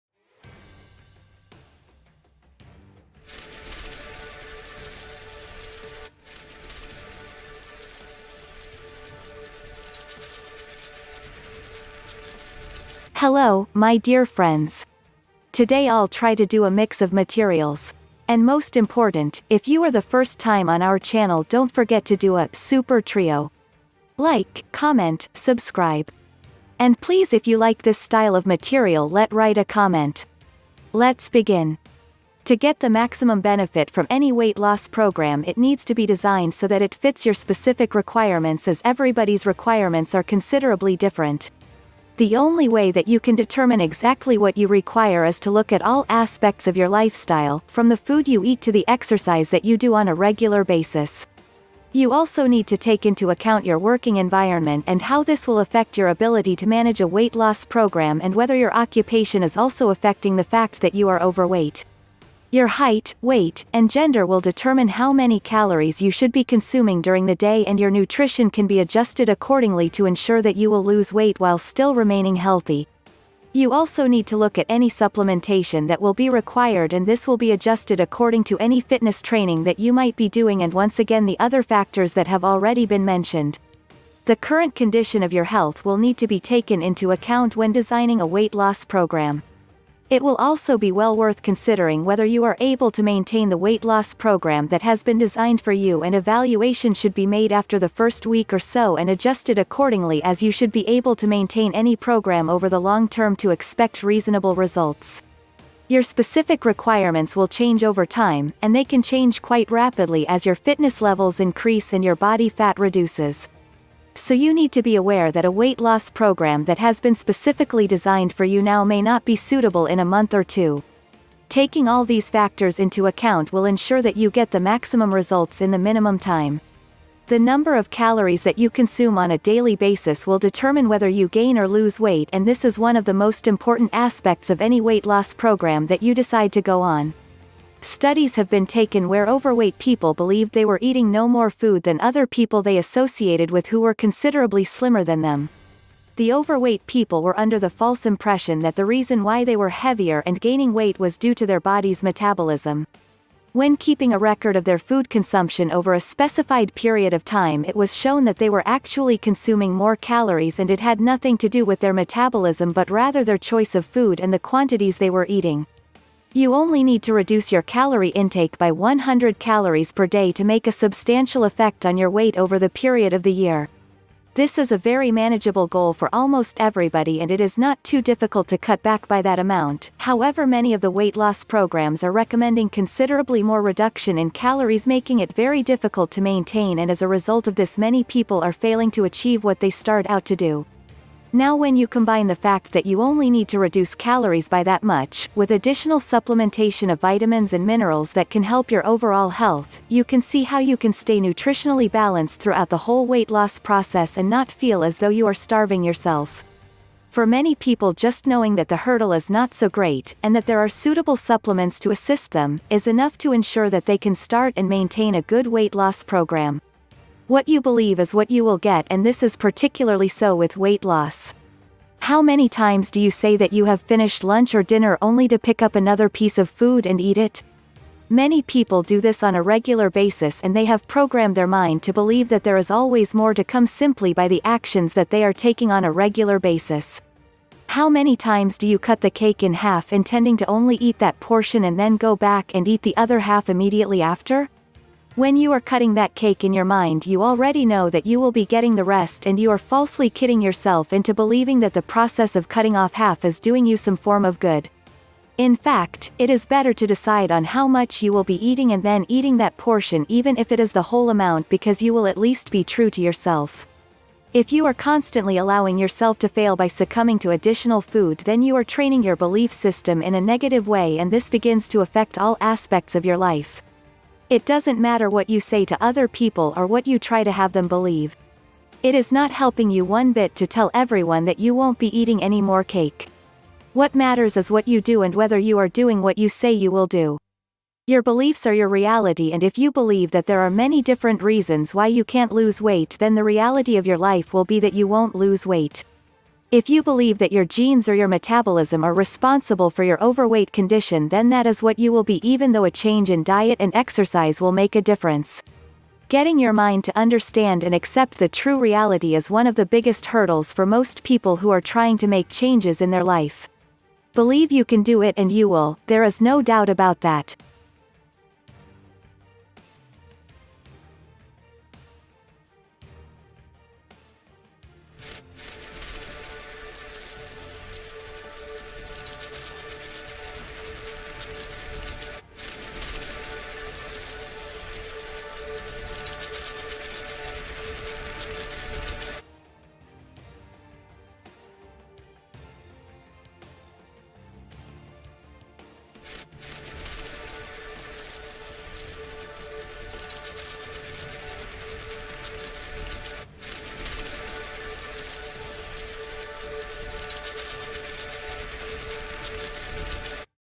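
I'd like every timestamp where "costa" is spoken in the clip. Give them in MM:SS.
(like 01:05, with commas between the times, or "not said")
not said.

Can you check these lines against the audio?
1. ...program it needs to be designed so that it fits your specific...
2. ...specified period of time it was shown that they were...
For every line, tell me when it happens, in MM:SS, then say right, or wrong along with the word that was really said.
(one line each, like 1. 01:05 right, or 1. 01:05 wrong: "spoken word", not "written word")
1. 00:34 right
2. 02:35 right.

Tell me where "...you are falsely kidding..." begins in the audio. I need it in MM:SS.
04:09.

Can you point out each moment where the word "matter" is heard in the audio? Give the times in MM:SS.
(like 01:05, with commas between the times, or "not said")
04:34, 04:43.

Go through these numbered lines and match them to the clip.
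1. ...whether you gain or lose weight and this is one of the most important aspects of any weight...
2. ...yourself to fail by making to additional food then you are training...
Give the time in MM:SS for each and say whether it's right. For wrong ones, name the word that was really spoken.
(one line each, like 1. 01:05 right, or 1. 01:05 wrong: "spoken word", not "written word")
1. 02:10 right
2. 04:25 wrong: "succumbing", not "making".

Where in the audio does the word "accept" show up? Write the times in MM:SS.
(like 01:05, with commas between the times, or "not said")
05:07.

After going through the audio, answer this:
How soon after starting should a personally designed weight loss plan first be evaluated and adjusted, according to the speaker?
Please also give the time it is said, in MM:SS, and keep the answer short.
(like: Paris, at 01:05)
after the first week, at 01:37.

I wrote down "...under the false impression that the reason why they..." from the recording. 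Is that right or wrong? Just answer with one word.
right.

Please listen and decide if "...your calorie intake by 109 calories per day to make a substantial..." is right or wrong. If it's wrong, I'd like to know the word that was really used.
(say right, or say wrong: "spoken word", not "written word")
wrong: "100", not "109".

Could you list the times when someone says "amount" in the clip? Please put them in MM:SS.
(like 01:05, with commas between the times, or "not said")
02:59, 04:21.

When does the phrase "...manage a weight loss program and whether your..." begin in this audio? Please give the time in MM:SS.
00:56.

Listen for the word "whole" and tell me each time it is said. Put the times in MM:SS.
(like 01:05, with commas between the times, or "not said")
03:22, 04:20.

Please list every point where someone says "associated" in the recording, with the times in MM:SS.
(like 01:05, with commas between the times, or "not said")
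02:22.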